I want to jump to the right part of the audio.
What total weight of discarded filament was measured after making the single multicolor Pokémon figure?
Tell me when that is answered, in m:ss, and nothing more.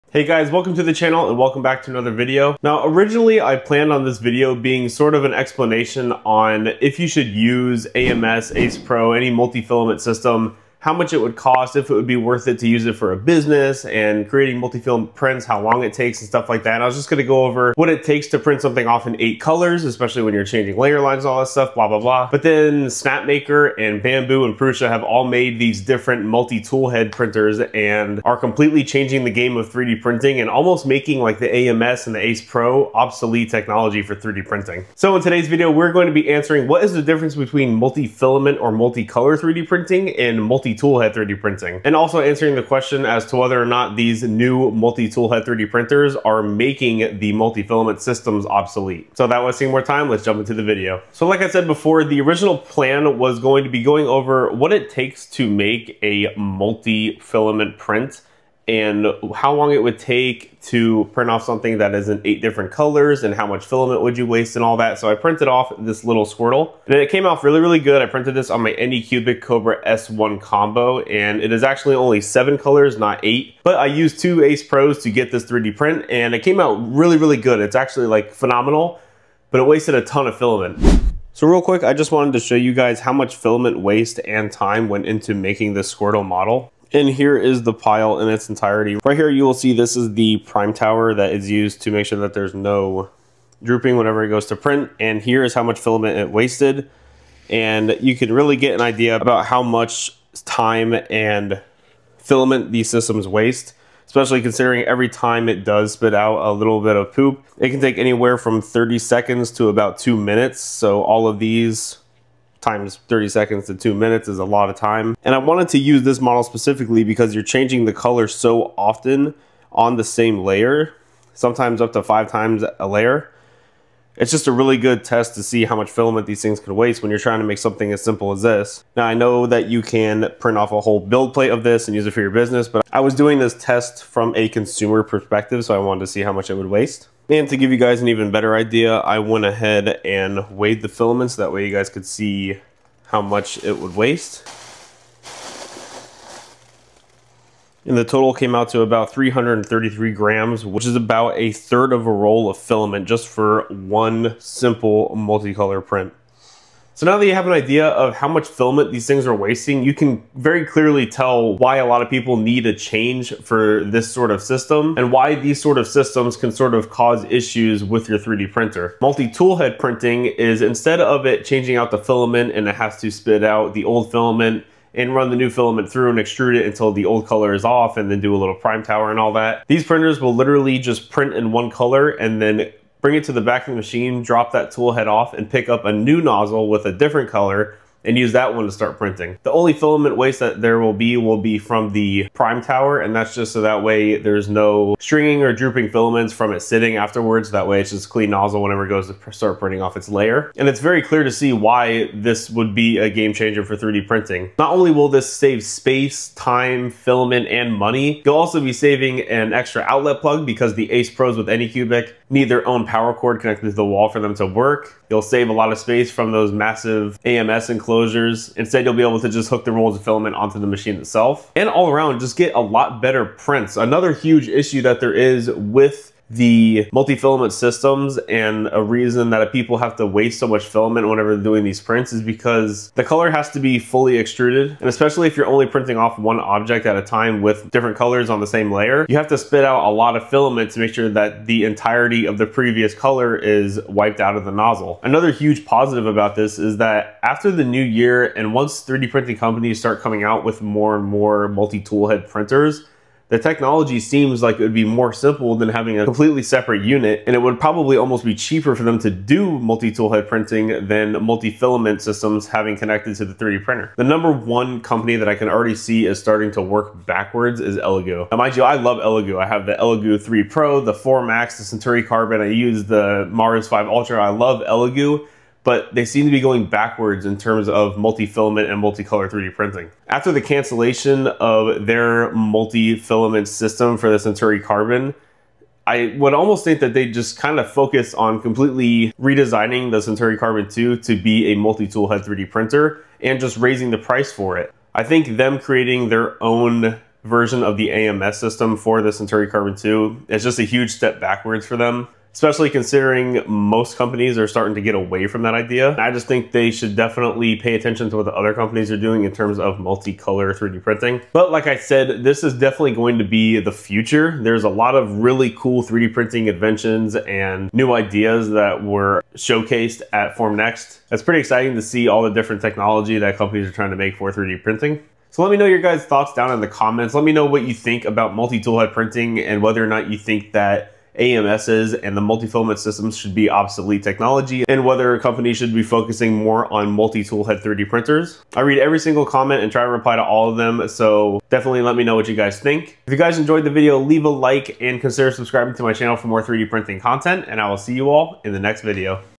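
2:29.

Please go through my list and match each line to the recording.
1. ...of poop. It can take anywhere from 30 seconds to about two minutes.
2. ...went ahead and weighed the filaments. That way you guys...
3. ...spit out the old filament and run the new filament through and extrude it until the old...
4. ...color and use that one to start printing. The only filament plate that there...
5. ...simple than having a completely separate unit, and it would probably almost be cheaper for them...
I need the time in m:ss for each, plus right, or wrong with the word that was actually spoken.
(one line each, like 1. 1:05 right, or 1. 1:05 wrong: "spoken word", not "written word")
1. 1:46 right
2. 2:19 right
3. 2:53 right
4. 3:07 wrong: "waste", not "plate"
5. 4:15 right.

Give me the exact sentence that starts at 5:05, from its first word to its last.
I just think they should definitely pay attention to what the other companies are doing in terms of multicolor 3D printing.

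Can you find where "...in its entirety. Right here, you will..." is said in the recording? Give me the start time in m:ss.
1:28.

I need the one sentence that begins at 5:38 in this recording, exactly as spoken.
I read every single comment and try to reply to all of them, so definitely let me know what you guys think.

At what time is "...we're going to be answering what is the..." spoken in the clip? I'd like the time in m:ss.
0:35.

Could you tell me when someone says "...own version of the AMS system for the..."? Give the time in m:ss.
4:56.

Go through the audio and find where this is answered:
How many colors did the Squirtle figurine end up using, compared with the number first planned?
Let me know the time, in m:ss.
1:12.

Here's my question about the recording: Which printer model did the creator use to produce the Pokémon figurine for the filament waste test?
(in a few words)
Anycubic Cobra S1 combo.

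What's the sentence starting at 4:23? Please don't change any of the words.
The number one company that I can already see is starting to work backwards is Elegoo.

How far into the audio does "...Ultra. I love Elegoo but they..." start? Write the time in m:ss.
4:33.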